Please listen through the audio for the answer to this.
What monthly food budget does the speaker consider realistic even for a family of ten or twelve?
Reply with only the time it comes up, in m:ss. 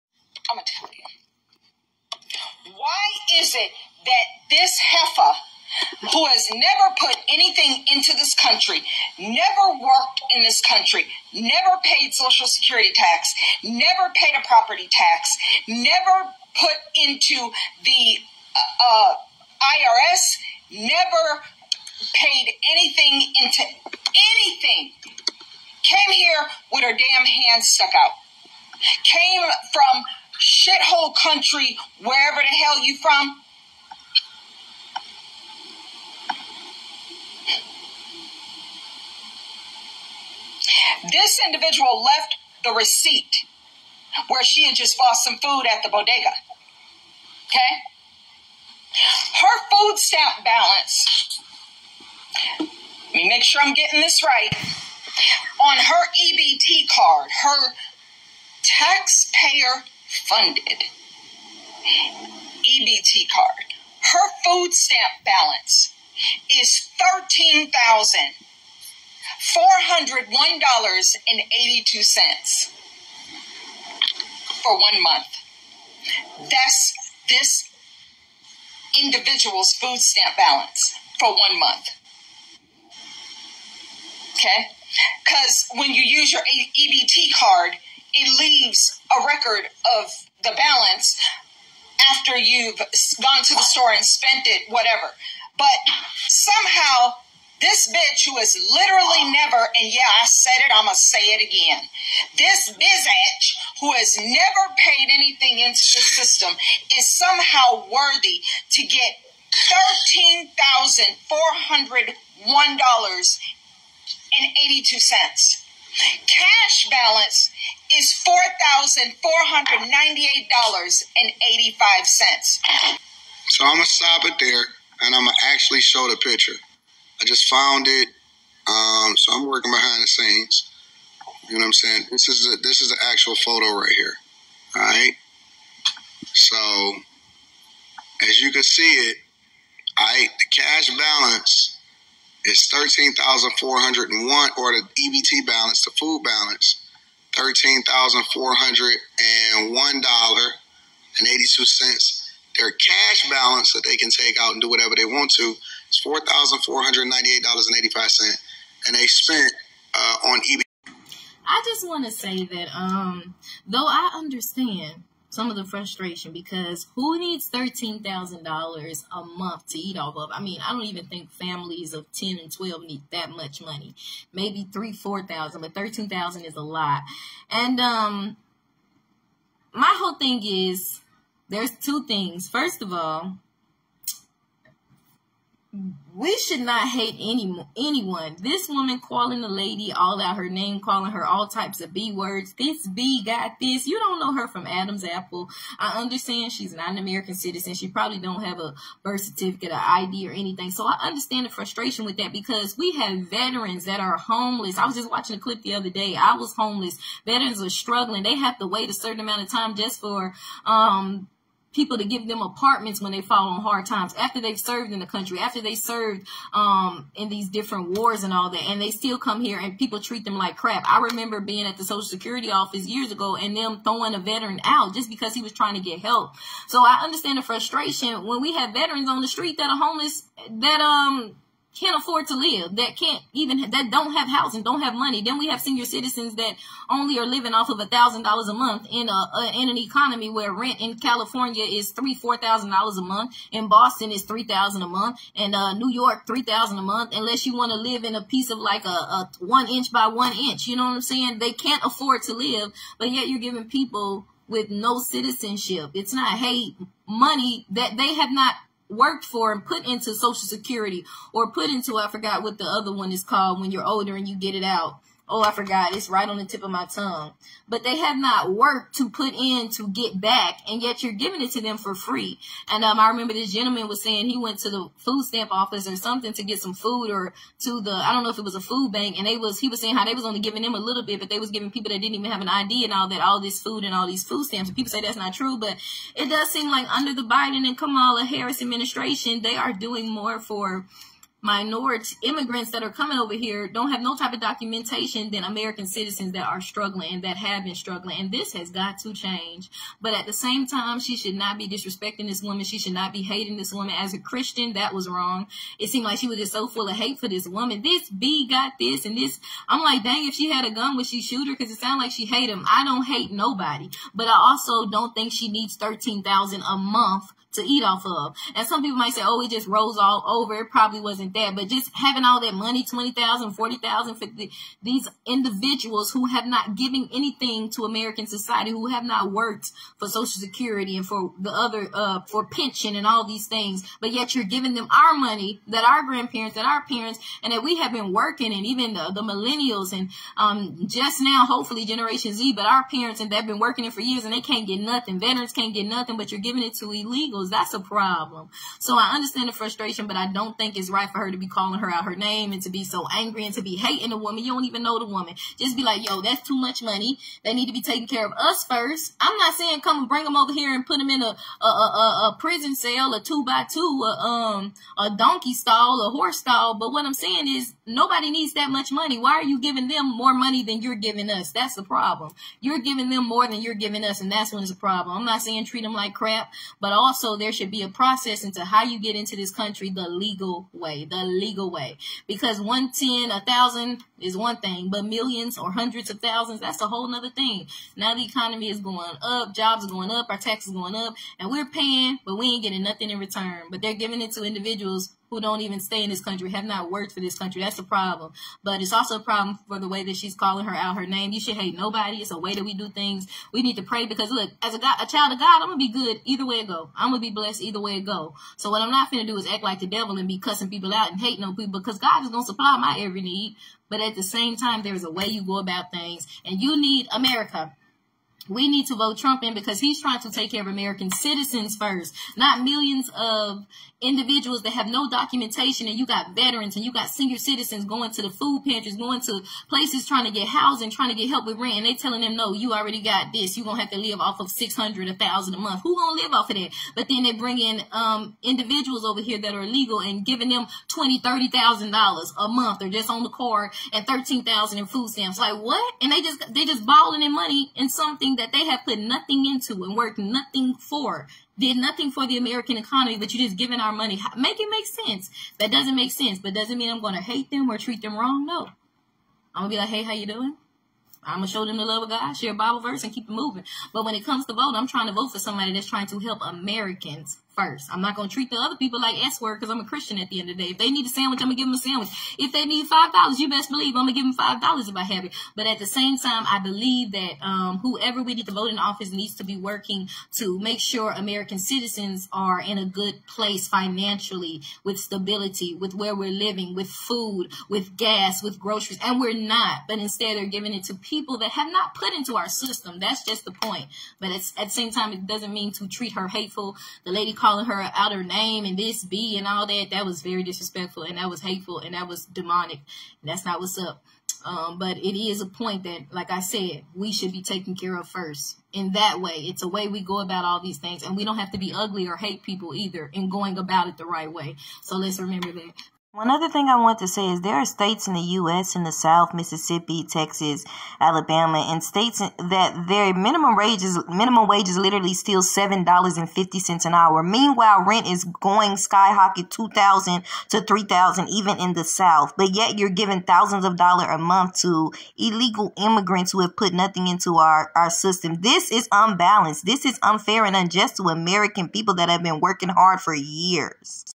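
2:54.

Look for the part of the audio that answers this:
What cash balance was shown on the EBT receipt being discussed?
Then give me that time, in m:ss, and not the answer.
1:59.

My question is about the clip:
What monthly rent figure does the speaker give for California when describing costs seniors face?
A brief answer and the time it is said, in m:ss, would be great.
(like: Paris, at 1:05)
3,000 to 4,000 dollars, at 4:01.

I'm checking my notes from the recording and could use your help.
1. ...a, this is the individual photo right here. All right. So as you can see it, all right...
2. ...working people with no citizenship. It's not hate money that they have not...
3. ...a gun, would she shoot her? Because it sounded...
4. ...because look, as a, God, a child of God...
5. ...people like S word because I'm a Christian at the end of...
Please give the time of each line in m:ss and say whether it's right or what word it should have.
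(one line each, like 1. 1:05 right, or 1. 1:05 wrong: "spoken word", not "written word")
1. 2:12 wrong: "actual", not "individual"
2. 4:13 wrong: "giving", not "working"
3. 5:10 right
4. 6:44 right
5. 7:48 right.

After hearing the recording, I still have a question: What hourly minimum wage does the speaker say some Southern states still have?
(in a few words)
$7.50.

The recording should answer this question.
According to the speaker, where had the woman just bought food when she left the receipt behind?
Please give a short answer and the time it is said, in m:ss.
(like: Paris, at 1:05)
bodega, at 0:45.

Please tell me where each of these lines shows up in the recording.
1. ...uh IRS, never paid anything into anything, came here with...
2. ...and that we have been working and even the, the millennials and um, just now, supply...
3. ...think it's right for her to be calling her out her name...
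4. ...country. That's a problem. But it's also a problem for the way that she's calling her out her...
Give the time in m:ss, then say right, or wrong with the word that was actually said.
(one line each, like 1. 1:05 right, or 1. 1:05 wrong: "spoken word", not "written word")
1. 0:18 right
2. 5:37 wrong: "hopefully", not "supply"
3. 5:50 right
4. 6:37 right.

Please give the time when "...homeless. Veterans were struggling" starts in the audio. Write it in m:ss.
3:26.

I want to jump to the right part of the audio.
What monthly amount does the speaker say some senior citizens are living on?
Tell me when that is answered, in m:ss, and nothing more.
3:57.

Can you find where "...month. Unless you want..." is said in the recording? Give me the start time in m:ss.
4:06.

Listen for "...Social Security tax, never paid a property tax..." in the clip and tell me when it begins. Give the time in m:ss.
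0:12.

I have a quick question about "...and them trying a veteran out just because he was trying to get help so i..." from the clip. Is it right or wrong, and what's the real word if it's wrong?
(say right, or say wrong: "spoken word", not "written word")
wrong: "throwing", not "trying".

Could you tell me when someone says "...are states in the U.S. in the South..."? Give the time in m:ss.
8:37.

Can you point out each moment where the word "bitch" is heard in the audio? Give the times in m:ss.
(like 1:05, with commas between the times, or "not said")
1:37, 1:42.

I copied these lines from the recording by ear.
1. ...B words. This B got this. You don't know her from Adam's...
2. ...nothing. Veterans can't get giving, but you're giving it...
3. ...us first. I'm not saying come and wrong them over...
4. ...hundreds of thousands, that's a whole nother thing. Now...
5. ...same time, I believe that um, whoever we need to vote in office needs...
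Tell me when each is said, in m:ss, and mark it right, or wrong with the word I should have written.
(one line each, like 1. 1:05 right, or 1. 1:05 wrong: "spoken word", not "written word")
1. 3:11 right
2. 5:44 wrong: "nothing", not "giving"
3. 5:58 wrong: "bring", not "wrong"
4. 6:25 right
5. 7:55 right.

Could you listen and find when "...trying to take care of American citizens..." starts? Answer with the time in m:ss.
7:00.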